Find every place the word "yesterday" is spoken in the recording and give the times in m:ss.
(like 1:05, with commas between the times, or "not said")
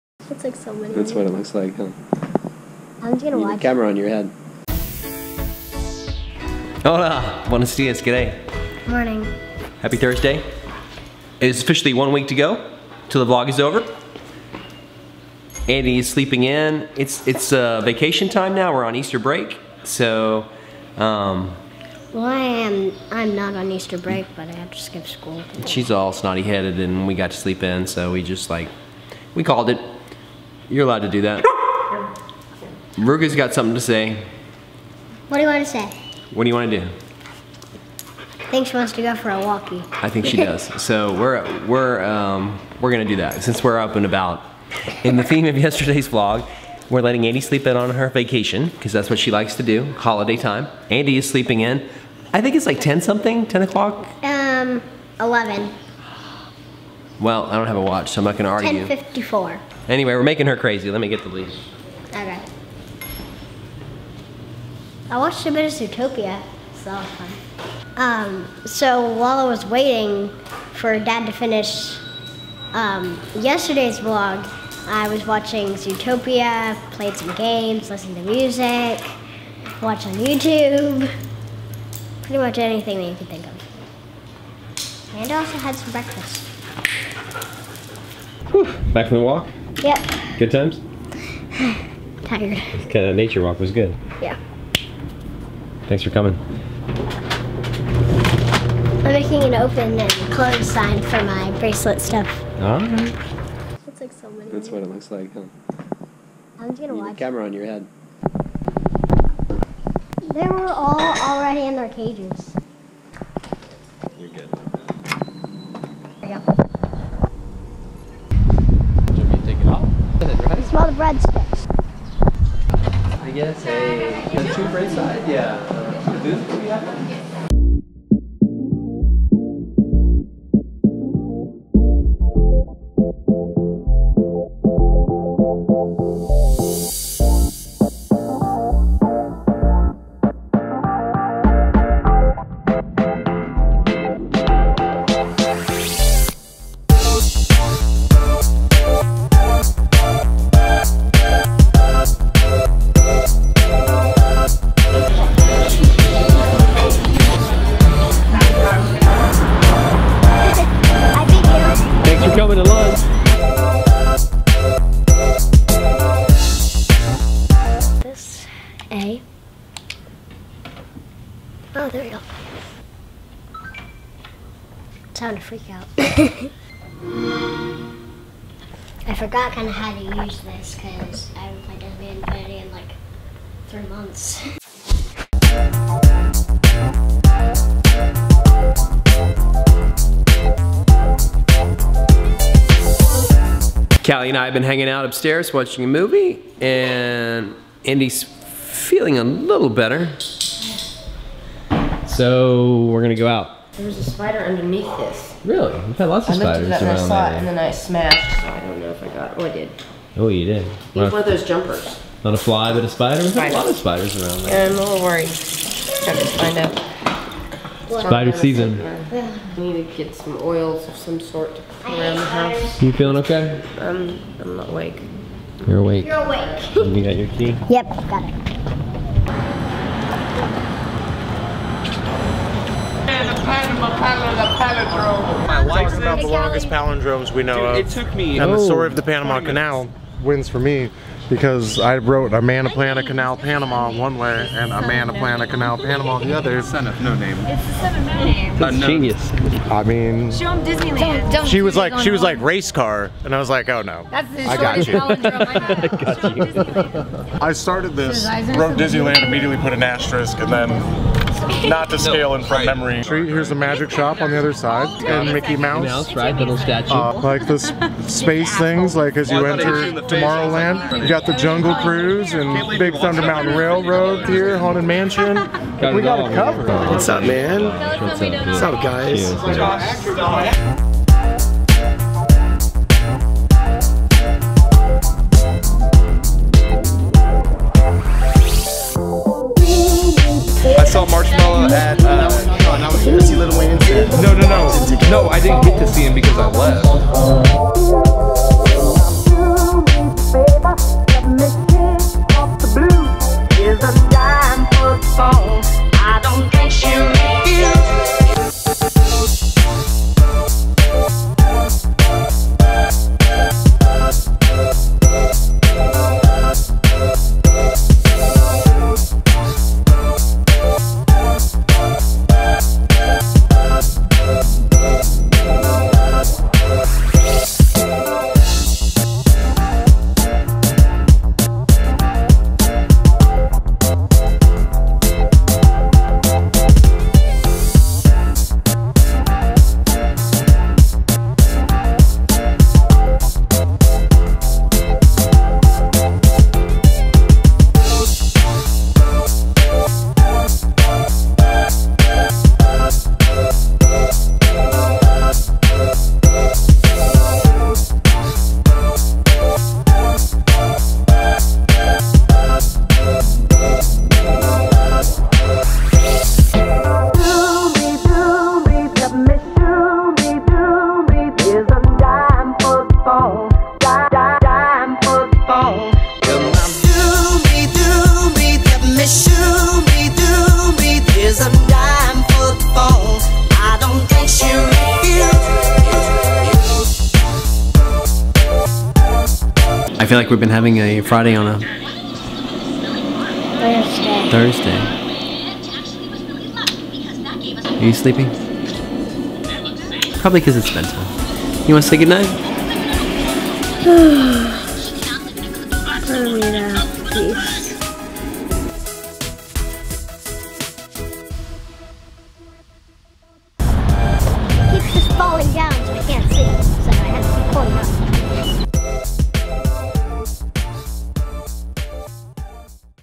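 0:45, 1:13.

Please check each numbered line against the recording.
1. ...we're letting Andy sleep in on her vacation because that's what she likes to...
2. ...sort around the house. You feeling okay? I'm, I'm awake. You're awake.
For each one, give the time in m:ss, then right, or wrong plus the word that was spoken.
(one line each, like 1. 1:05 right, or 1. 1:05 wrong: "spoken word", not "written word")
1. 0:46 right
2. 3:41 right.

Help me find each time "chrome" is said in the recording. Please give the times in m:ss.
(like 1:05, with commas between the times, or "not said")
not said.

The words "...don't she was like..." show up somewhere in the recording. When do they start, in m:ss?
4:11.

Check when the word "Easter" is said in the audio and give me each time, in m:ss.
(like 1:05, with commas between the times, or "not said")
0:18, 0:23.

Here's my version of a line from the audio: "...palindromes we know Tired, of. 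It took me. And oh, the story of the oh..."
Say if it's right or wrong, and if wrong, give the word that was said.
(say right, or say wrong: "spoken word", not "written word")
wrong: "Dude", not "Tired".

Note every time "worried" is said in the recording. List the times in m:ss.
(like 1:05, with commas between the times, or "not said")
3:35.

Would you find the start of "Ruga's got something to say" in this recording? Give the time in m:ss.
0:32.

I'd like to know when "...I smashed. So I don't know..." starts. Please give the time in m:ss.
3:27.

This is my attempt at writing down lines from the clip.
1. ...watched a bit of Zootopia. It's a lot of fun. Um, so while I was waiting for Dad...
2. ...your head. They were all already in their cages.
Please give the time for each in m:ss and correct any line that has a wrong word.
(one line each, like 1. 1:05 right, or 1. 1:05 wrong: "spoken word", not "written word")
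1. 1:05 right
2. 1:47 right.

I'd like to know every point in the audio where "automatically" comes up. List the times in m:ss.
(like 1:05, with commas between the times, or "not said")
not said.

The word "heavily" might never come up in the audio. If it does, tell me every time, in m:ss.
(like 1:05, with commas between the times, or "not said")
not said.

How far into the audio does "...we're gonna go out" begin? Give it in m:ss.
3:22.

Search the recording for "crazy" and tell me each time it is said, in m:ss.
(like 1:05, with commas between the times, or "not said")
1:00.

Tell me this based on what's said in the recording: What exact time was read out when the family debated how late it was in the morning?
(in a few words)
10:54.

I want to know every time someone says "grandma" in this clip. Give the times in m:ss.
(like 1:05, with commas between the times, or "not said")
not said.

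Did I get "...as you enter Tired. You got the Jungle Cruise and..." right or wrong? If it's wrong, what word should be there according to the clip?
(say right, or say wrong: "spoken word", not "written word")
wrong: "Tomorrowland", not "Tired".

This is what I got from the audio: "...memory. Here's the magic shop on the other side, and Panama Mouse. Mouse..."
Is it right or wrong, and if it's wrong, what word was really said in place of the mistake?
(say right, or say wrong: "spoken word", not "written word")
wrong: "Mickey", not "Panama".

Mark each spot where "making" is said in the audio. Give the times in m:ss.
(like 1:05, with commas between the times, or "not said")
1:00, 1:39.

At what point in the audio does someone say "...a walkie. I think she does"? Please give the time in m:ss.
0:39.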